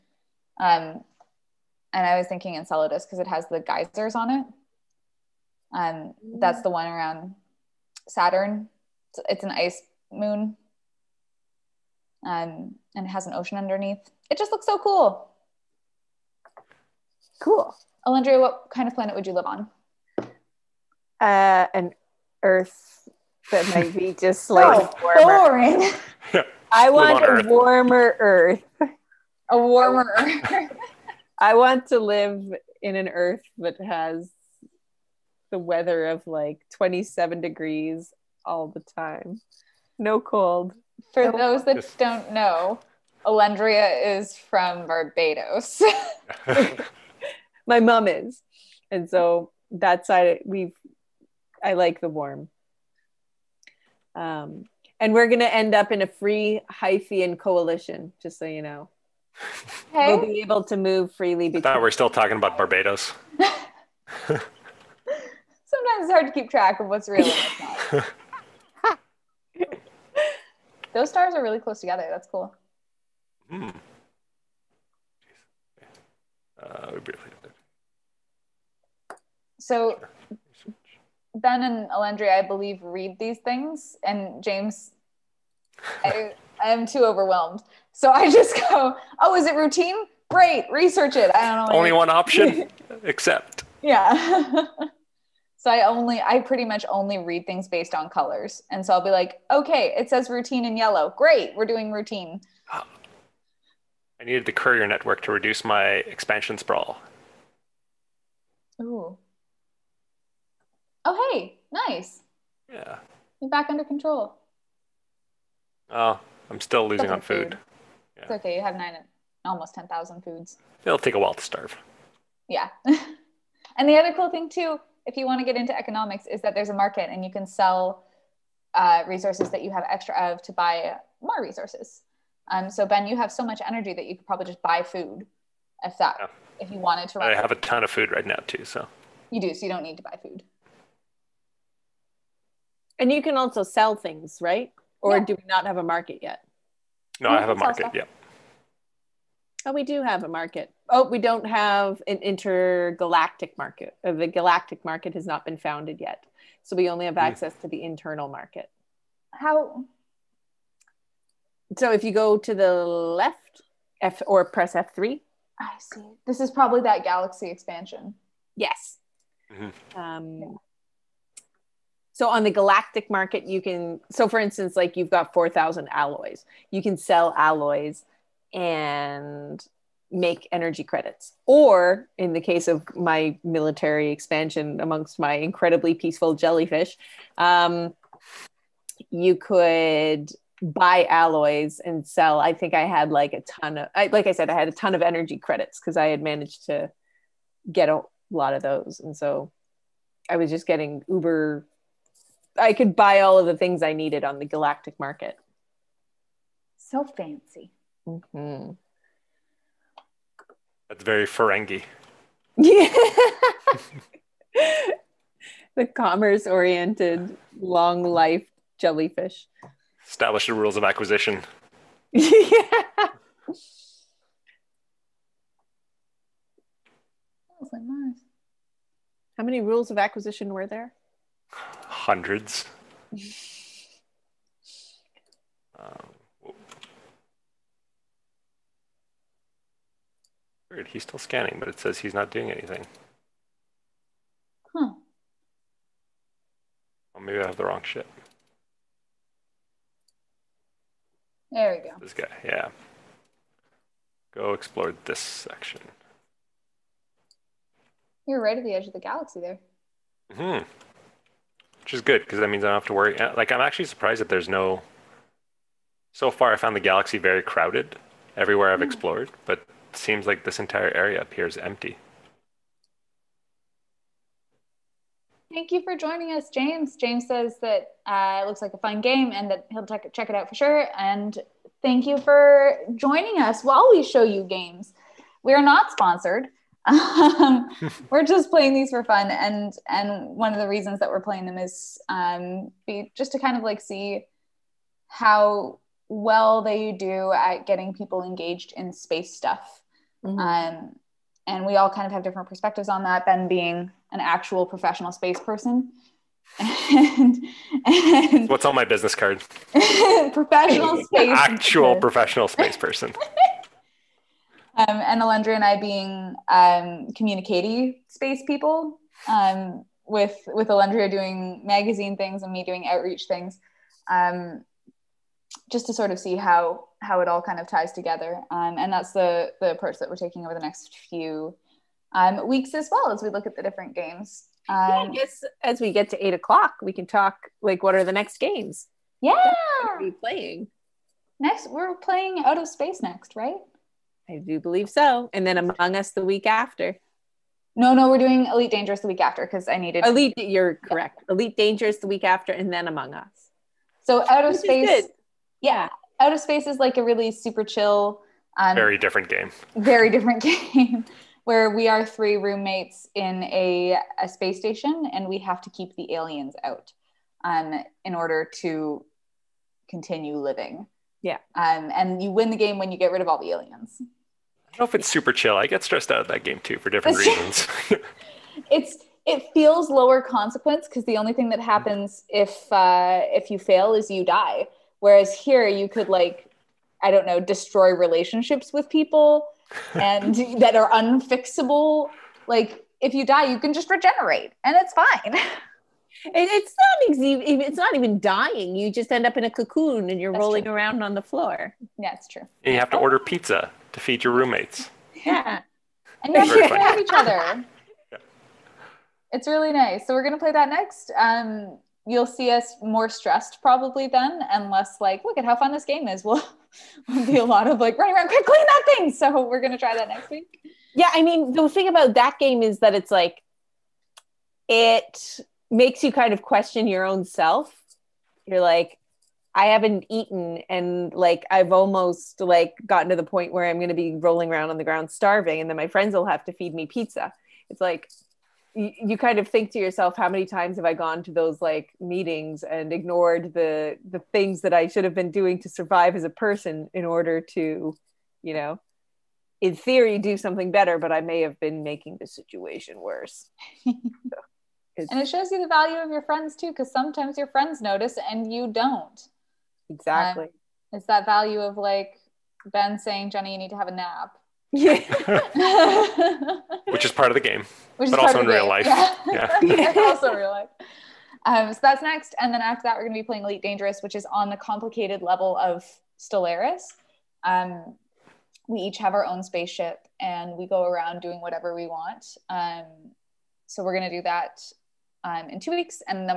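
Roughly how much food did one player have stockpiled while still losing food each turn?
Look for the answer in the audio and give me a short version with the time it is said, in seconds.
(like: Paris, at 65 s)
almost 10,000, at 119 s.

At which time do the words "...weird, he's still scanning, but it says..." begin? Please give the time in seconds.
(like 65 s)
240 s.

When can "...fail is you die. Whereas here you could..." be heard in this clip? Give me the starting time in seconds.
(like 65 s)
383 s.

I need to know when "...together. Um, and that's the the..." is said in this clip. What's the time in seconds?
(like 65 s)
327 s.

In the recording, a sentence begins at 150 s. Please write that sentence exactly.
Oh, we don't have an intergalactic market.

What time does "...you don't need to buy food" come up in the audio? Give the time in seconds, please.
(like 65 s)
139 s.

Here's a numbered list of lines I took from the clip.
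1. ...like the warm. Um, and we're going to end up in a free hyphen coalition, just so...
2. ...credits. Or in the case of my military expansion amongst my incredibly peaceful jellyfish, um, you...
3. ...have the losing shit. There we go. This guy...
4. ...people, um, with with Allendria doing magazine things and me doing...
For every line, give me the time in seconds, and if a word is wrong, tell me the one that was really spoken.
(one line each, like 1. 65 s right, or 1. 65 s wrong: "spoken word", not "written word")
1. 51 s right
2. 180 s right
3. 247 s wrong: "wrong", not "losing"
4. 318 s right.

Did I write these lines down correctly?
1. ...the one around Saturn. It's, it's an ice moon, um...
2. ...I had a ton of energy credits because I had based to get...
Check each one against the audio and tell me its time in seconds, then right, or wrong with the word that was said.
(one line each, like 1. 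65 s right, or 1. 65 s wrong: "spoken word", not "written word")
1. 6 s right
2. 194 s wrong: "managed", not "based".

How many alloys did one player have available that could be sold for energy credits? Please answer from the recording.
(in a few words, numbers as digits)
4,000.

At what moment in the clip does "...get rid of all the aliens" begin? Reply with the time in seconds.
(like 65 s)
372 s.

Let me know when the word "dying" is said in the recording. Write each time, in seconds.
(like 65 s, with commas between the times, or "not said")
398 s.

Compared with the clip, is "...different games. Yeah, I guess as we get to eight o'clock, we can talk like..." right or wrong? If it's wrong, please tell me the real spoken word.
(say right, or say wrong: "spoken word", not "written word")
right.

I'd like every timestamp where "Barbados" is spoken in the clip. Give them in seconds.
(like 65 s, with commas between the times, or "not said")
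44 s, 62 s.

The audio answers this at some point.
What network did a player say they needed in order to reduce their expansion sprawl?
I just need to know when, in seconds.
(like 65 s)
104 s.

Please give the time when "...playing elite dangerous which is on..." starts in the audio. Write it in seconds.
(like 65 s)
473 s.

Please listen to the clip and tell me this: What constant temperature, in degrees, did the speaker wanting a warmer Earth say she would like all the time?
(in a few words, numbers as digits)
27.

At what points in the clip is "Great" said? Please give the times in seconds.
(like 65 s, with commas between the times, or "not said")
90 s, 101 s.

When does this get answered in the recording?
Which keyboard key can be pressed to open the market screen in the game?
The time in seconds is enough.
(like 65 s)
164 s.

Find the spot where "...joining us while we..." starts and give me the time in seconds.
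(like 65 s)
282 s.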